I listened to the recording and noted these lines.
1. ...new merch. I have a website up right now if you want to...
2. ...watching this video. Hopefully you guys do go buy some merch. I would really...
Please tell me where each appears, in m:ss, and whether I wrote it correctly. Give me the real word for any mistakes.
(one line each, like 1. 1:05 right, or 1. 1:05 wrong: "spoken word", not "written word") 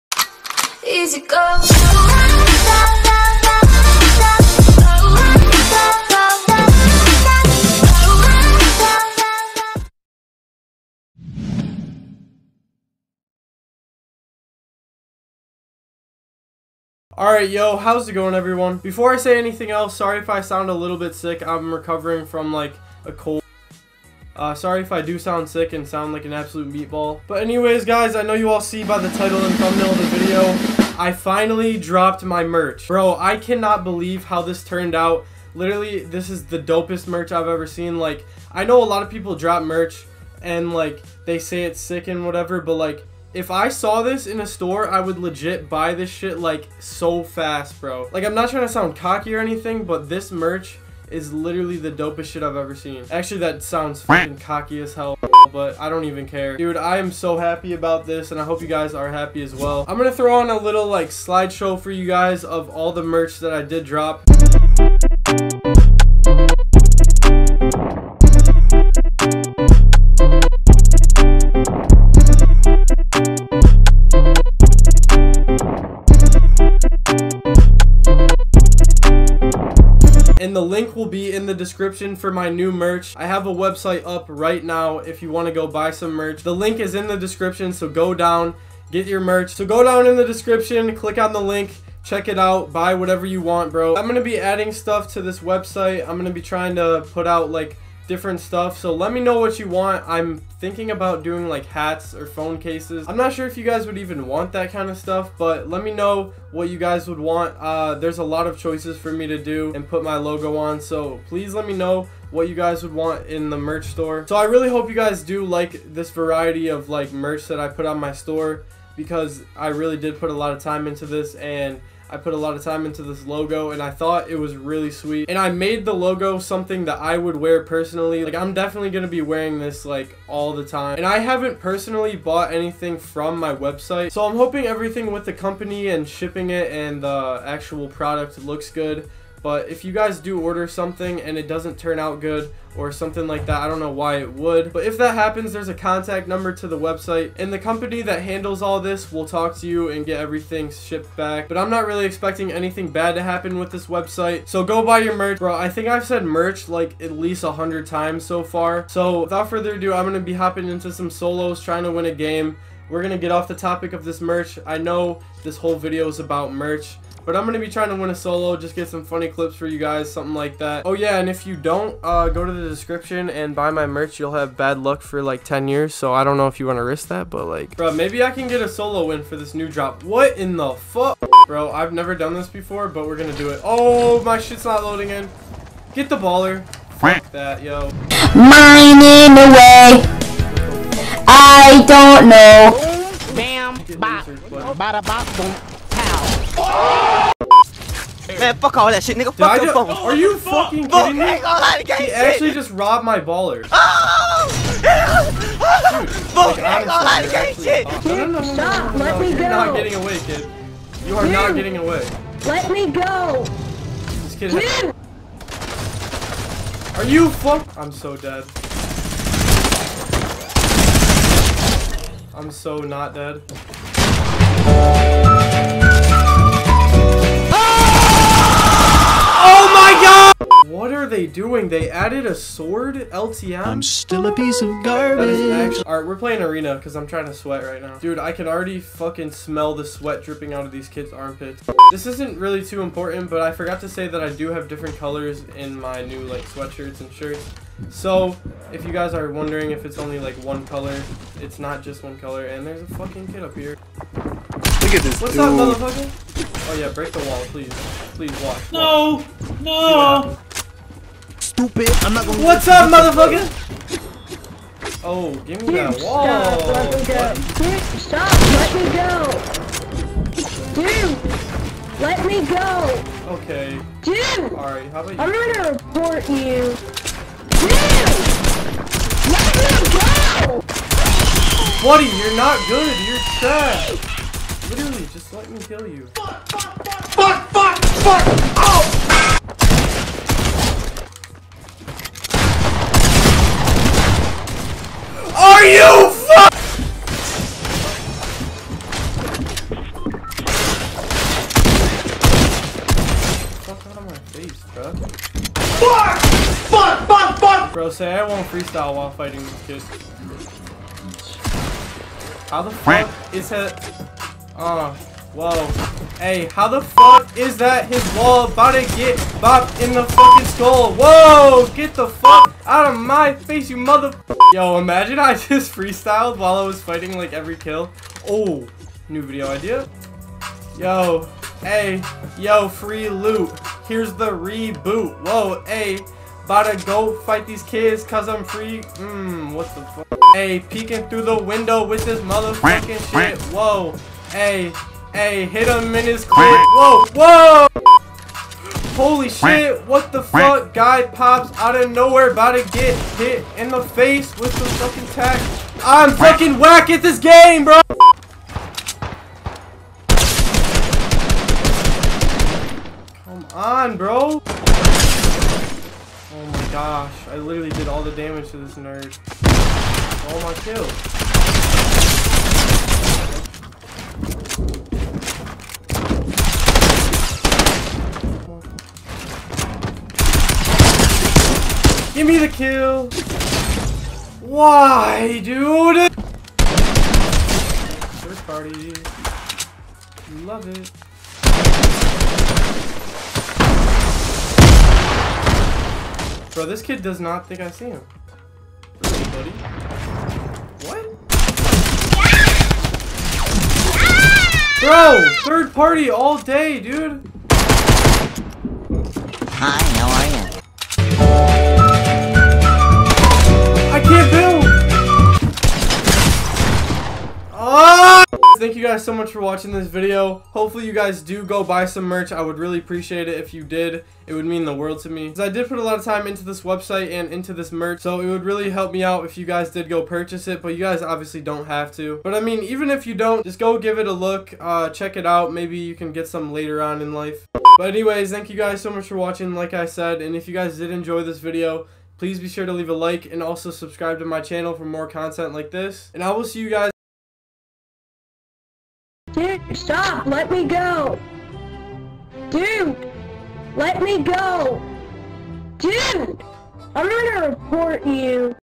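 1. 1:22 right
2. 6:59 right.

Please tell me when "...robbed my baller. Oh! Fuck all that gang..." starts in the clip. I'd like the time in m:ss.
3:22.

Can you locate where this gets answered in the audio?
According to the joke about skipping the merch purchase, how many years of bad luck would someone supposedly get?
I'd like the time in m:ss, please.
2:55.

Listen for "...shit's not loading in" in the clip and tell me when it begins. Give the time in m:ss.
3:04.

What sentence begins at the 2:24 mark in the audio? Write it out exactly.
But if that happens, there's a contact number to the website.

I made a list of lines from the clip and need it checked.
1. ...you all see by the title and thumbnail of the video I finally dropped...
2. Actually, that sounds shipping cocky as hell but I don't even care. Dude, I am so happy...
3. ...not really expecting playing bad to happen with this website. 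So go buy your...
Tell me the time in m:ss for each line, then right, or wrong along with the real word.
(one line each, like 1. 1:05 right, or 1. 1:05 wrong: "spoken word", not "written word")
1. 0:28 right
2. 0:53 wrong: "fucking", not "shipping"
3. 2:31 wrong: "anything", not "playing".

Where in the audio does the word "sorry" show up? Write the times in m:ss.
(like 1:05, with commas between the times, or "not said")
0:19, 0:24.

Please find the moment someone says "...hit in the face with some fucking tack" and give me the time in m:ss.
5:53.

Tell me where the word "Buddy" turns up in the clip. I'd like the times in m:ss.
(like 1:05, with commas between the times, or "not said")
4:41, 6:39.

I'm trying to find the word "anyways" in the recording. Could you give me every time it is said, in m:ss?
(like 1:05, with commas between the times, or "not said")
0:27, 7:17.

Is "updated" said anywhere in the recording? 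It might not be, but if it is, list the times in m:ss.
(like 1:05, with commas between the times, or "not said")
not said.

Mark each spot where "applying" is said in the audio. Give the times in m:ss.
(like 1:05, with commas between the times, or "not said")
not said.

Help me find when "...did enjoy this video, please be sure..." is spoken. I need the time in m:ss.
7:20.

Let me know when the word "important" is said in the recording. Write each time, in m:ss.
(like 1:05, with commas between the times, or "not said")
4:02.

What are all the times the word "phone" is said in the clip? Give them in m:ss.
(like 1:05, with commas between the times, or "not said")
1:42, 3:19.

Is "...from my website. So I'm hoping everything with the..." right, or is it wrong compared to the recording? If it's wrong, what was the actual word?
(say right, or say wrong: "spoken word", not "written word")
right.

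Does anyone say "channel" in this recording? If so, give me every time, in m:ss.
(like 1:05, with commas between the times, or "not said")
7:24.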